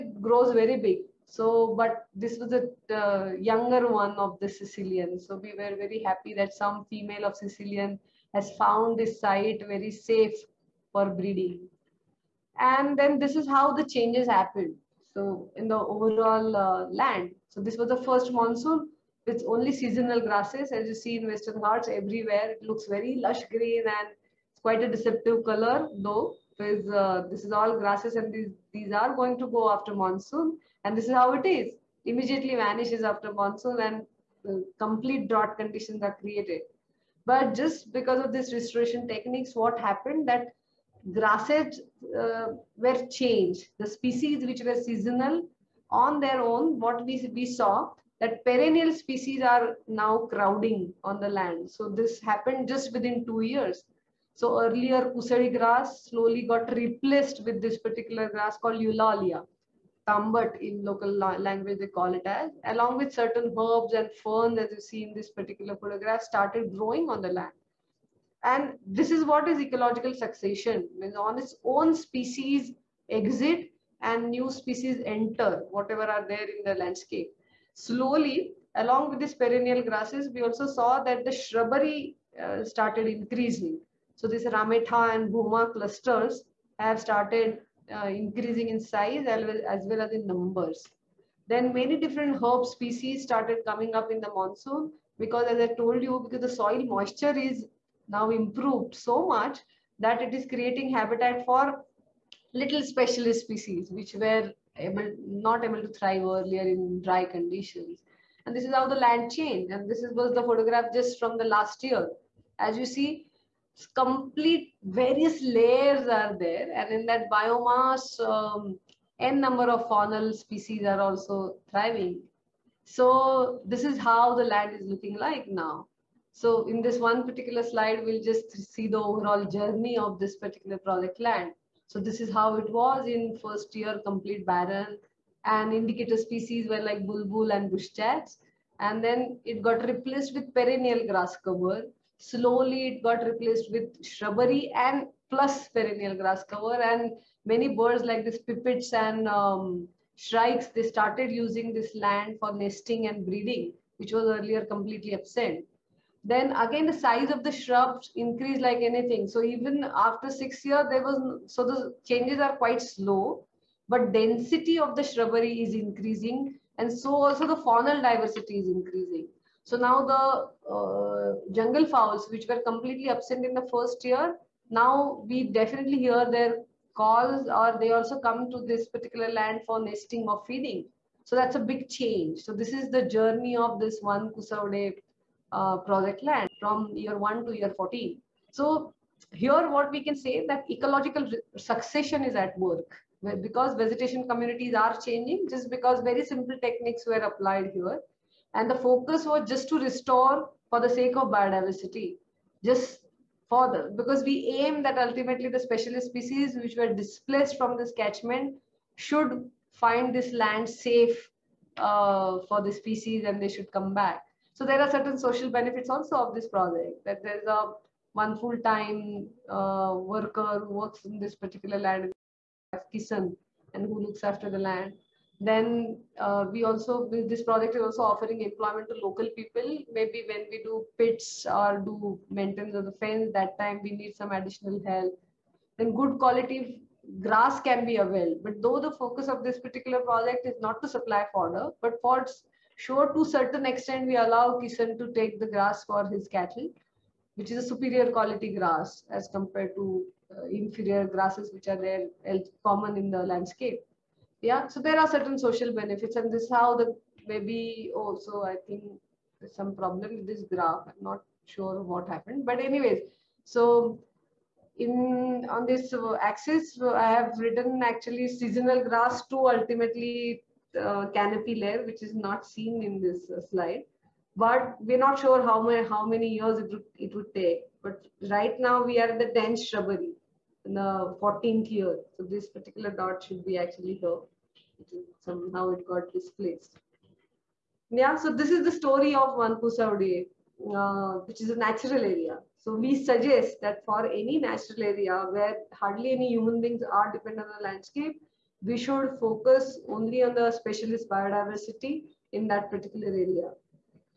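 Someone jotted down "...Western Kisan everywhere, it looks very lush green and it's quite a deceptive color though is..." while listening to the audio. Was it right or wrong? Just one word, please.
wrong.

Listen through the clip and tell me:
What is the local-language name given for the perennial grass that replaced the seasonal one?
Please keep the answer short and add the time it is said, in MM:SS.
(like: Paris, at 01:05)
Tambat, at 01:00.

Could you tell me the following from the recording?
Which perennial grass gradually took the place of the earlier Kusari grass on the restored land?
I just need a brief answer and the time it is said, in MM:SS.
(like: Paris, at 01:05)
Eulalia, at 00:58.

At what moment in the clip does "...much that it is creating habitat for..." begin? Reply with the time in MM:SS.
01:39.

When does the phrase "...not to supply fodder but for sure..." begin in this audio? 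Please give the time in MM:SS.
04:00.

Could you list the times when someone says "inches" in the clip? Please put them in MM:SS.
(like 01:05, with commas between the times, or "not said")
not said.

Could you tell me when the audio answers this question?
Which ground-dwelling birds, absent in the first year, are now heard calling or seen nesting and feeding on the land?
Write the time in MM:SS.
02:51.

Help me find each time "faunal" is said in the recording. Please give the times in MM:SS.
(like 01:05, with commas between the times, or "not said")
01:59, 02:47.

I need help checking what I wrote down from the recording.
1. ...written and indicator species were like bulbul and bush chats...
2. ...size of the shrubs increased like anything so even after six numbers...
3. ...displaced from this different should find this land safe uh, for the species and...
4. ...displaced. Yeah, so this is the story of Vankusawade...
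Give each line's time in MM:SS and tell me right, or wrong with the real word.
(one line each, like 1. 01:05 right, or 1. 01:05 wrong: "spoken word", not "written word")
1. 02:14 wrong: "barren", not "written"
2. 02:37 wrong: "years", not "numbers"
3. 03:26 wrong: "catchment", not "different"
4. 04:46 right.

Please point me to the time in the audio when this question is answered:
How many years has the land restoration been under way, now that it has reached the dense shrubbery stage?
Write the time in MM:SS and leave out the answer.
04:41.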